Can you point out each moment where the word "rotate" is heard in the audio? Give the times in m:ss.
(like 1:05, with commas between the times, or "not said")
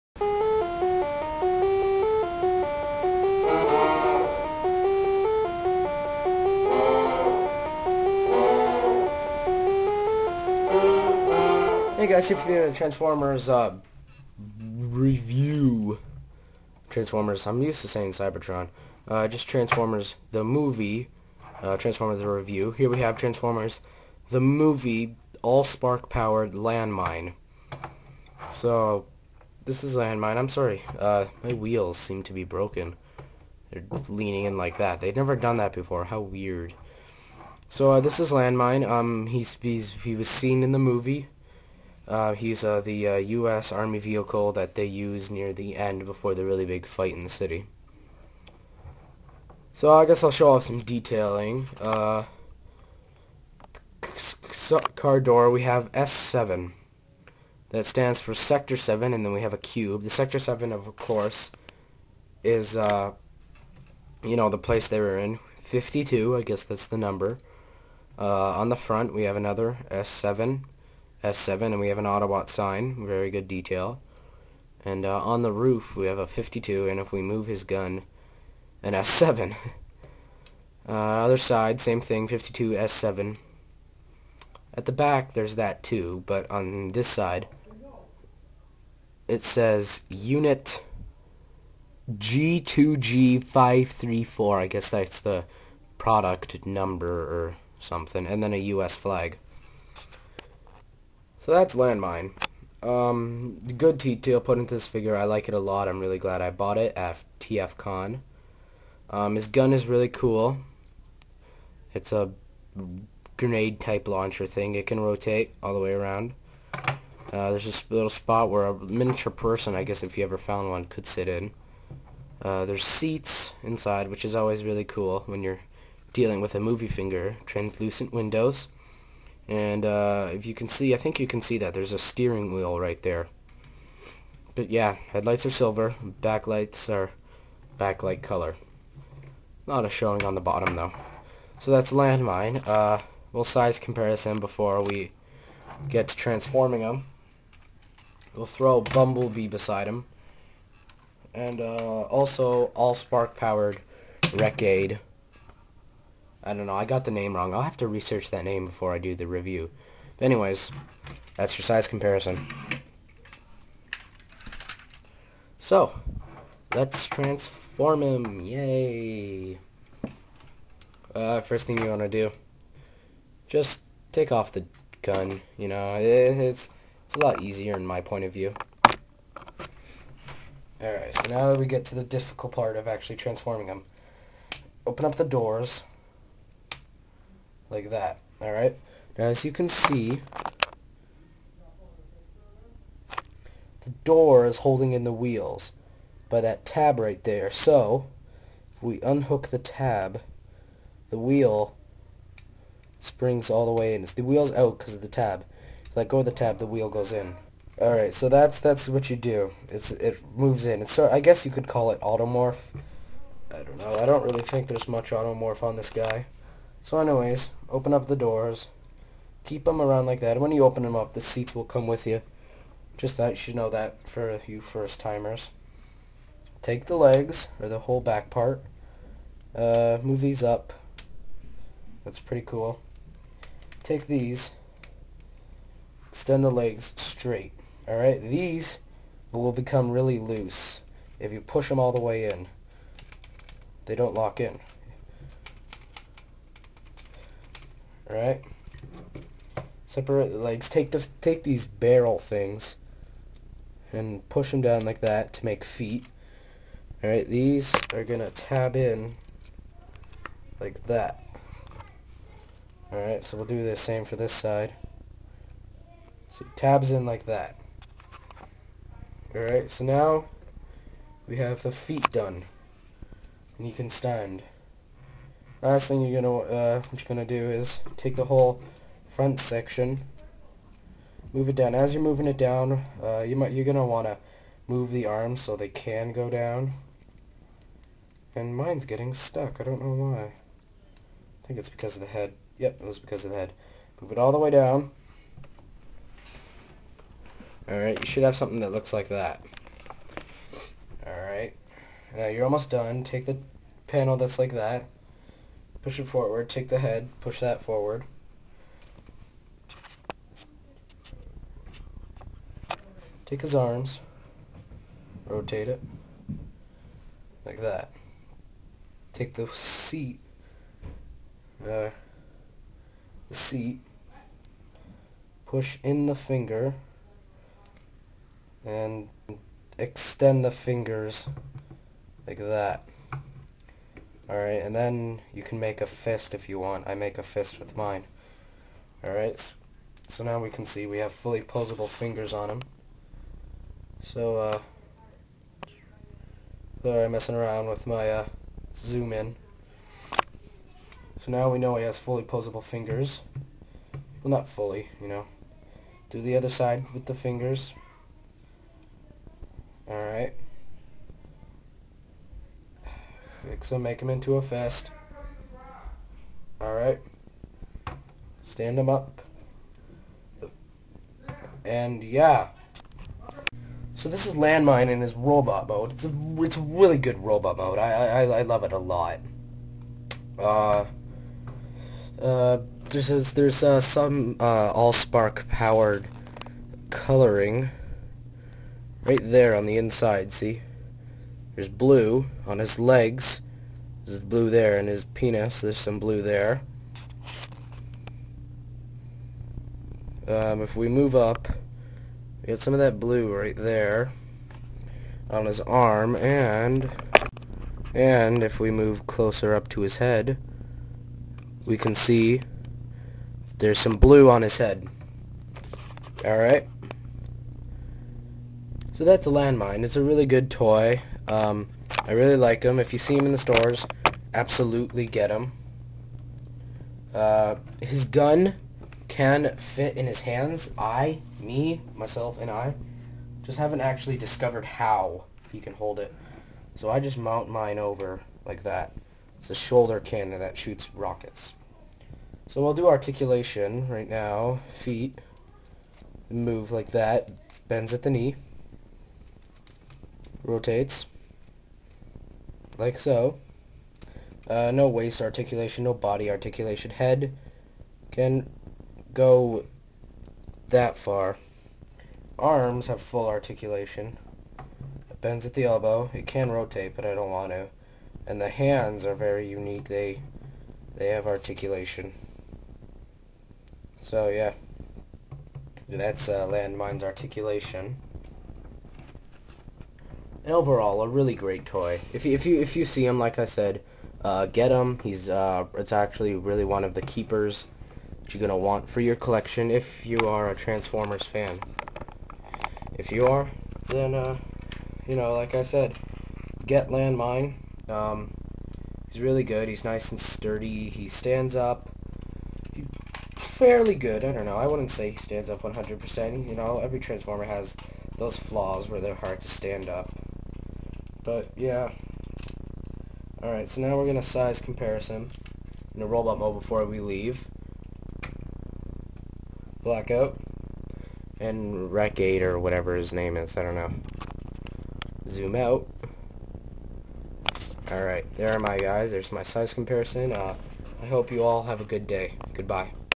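1:54, 5:15, 7:30, 7:46.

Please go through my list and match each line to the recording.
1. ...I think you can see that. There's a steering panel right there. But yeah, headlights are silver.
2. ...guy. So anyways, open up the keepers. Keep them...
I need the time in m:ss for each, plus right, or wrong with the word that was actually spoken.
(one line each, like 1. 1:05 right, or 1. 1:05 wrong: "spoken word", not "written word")
1. 2:10 wrong: "wheel", not "panel"
2. 3:35 wrong: "doors", not "keepers".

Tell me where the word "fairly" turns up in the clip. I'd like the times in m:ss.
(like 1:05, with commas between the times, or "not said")
8:23.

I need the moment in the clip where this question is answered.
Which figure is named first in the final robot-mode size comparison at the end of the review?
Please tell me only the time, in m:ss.
8:39.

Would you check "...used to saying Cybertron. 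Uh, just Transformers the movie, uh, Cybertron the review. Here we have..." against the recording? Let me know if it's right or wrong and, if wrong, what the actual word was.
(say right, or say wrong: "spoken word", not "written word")
wrong: "Transformers", not "Cybertron".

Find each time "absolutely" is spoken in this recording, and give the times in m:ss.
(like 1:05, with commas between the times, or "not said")
7:04.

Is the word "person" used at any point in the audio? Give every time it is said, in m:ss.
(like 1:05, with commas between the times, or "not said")
1:59.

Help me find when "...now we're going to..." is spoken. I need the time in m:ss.
8:33.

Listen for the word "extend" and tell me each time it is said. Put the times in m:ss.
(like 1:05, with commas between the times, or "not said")
3:56, 5:29.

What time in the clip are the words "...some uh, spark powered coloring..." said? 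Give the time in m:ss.
6:23.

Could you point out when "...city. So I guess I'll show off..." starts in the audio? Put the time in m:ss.
0:47.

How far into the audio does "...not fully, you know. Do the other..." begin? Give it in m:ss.
5:54.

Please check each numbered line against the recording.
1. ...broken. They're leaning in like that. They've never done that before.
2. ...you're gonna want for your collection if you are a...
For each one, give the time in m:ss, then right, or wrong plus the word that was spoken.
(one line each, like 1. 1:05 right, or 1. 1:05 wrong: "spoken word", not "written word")
1. 0:32 right
2. 8:08 right.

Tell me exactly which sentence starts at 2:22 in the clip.
Uh, we'll size comparison before we get to transforming them.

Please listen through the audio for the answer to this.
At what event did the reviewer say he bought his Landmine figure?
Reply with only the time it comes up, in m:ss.
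1:47.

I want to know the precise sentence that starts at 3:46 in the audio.
Take the legs, or the whole back part.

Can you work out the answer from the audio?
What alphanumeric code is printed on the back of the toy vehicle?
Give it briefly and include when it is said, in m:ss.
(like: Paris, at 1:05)
G2G534, at 1:30.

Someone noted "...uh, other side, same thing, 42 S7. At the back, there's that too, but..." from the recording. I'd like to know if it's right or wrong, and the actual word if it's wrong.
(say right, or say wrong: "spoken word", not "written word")
wrong: "52", not "42".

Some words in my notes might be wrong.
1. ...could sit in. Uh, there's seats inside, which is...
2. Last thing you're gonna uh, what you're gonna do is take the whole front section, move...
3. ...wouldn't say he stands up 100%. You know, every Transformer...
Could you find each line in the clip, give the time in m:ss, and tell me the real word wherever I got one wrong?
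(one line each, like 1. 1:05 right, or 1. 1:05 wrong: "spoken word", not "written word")
1. 2:00 right
2. 4:35 right
3. 8:24 right.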